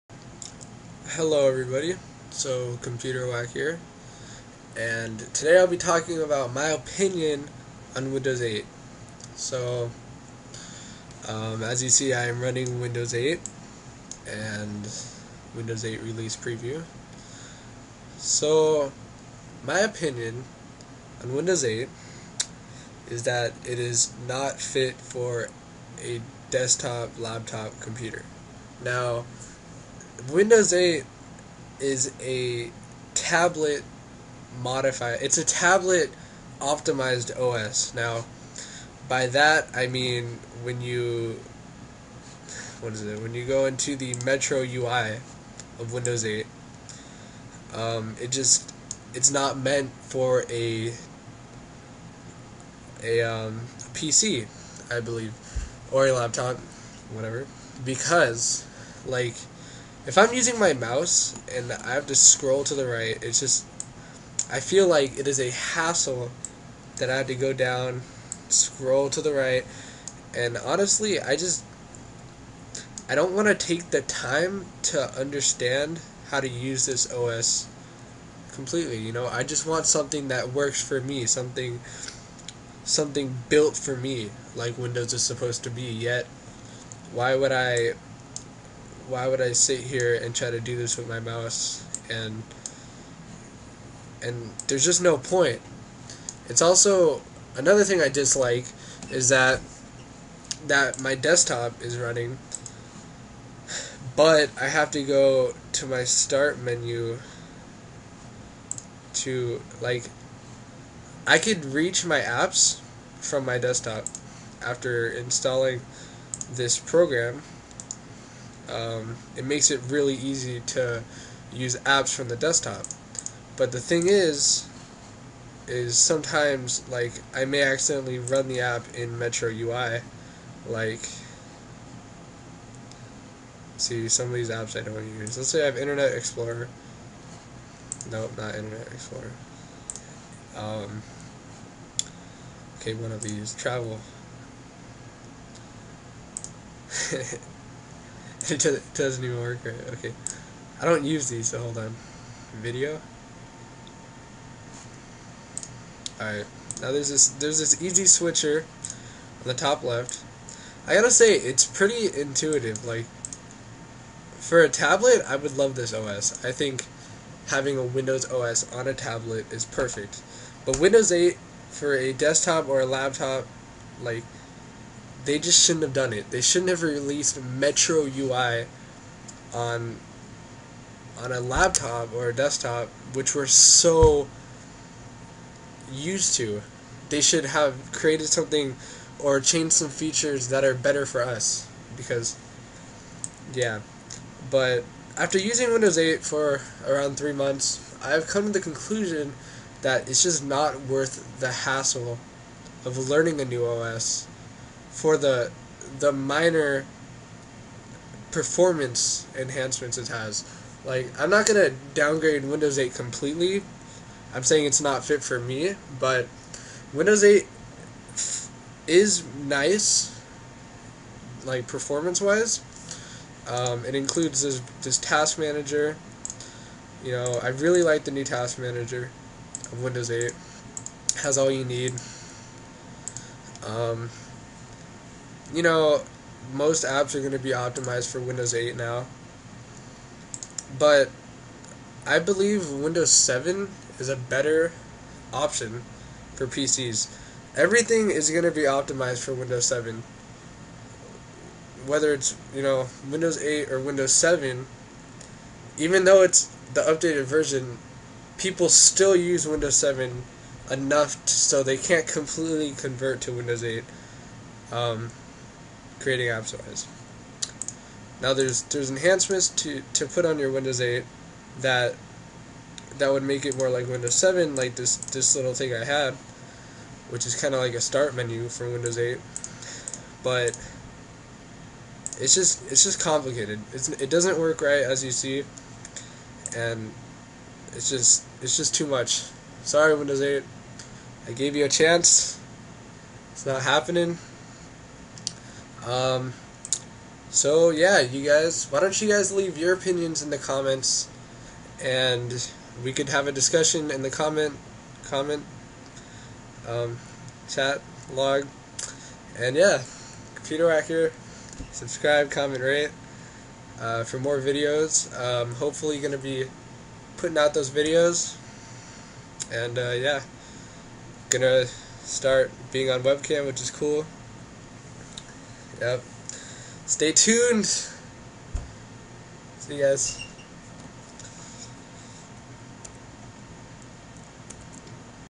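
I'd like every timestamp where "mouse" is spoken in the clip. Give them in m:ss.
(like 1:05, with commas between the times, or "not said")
1:00, 1:31.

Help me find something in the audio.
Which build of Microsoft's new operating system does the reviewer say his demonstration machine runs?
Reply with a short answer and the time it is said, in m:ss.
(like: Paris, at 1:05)
Release preview, at 0:15.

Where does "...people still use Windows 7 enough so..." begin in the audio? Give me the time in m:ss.
4:18.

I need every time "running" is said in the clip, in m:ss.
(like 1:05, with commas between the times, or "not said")
0:12, 1:41.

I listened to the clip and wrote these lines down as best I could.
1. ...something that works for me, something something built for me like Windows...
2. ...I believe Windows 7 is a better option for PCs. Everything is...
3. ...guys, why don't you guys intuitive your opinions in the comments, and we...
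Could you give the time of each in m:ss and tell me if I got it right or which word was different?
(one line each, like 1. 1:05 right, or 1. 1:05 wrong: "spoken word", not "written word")
1. 1:19 right
2. 4:02 right
3. 4:58 wrong: "leave", not "intuitive".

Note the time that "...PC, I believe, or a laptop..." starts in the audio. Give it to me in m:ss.
0:53.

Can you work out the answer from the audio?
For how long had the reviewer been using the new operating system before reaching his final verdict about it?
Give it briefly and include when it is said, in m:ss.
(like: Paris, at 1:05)
3 months, at 3:16.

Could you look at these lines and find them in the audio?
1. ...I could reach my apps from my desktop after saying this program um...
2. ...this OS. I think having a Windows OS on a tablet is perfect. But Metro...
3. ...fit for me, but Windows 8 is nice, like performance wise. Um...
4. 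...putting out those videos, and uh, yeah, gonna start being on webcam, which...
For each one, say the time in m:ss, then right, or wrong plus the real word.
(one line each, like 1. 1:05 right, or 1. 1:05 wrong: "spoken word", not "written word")
1. 1:51 wrong: "installing", not "saying"
2. 2:45 wrong: "Windows", not "Metro"
3. 3:35 right
4. 5:17 right.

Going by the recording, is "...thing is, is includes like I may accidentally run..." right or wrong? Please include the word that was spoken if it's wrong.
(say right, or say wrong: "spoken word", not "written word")
wrong: "sometimes", not "includes".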